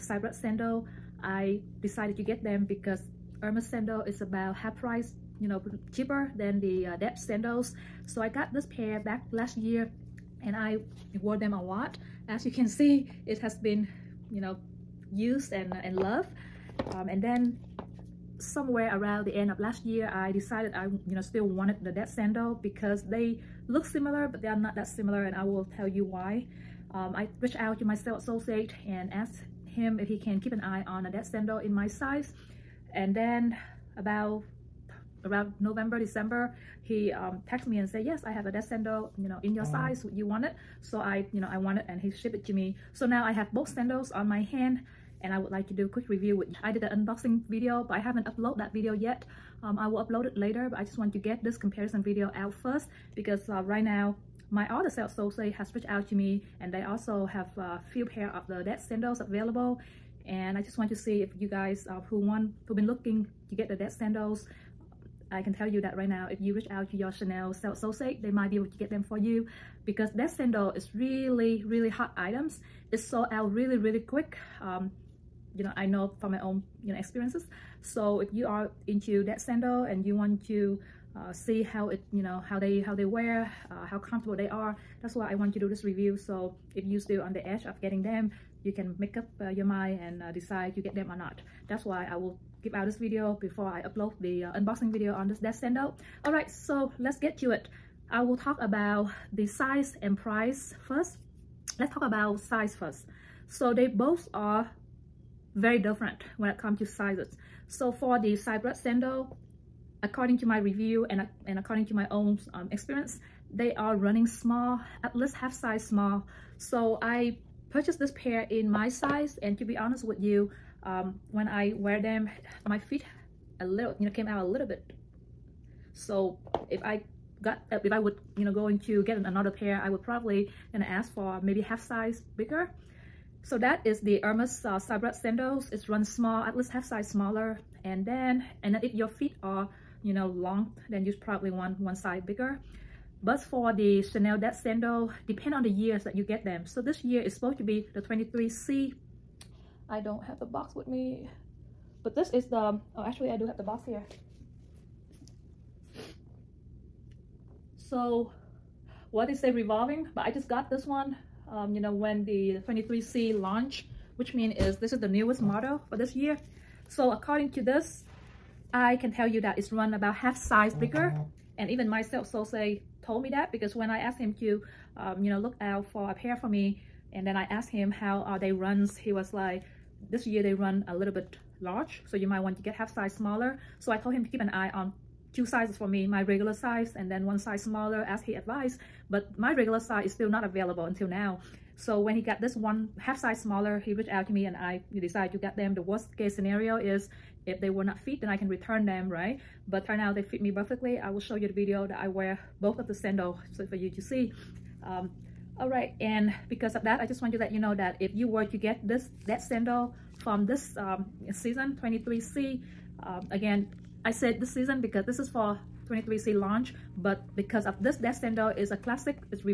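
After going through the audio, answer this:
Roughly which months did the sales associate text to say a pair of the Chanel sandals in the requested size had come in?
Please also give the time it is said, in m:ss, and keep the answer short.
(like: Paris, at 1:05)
November, December, at 0:35.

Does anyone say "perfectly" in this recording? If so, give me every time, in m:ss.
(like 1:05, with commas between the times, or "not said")
3:20.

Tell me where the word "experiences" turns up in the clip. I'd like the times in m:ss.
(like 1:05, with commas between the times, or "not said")
1:16, 1:52.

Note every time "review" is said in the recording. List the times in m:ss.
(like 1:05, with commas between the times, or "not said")
0:46, 1:25, 1:50.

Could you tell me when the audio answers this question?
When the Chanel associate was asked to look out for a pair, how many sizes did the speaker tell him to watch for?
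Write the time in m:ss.
3:05.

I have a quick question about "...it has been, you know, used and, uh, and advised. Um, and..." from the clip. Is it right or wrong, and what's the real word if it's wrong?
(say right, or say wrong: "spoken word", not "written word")
wrong: "loved", not "advised".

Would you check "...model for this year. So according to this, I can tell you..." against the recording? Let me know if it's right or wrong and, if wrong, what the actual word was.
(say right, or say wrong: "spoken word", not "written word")
right.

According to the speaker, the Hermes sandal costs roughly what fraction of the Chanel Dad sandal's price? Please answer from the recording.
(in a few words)
half price.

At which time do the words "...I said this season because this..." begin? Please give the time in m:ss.
3:34.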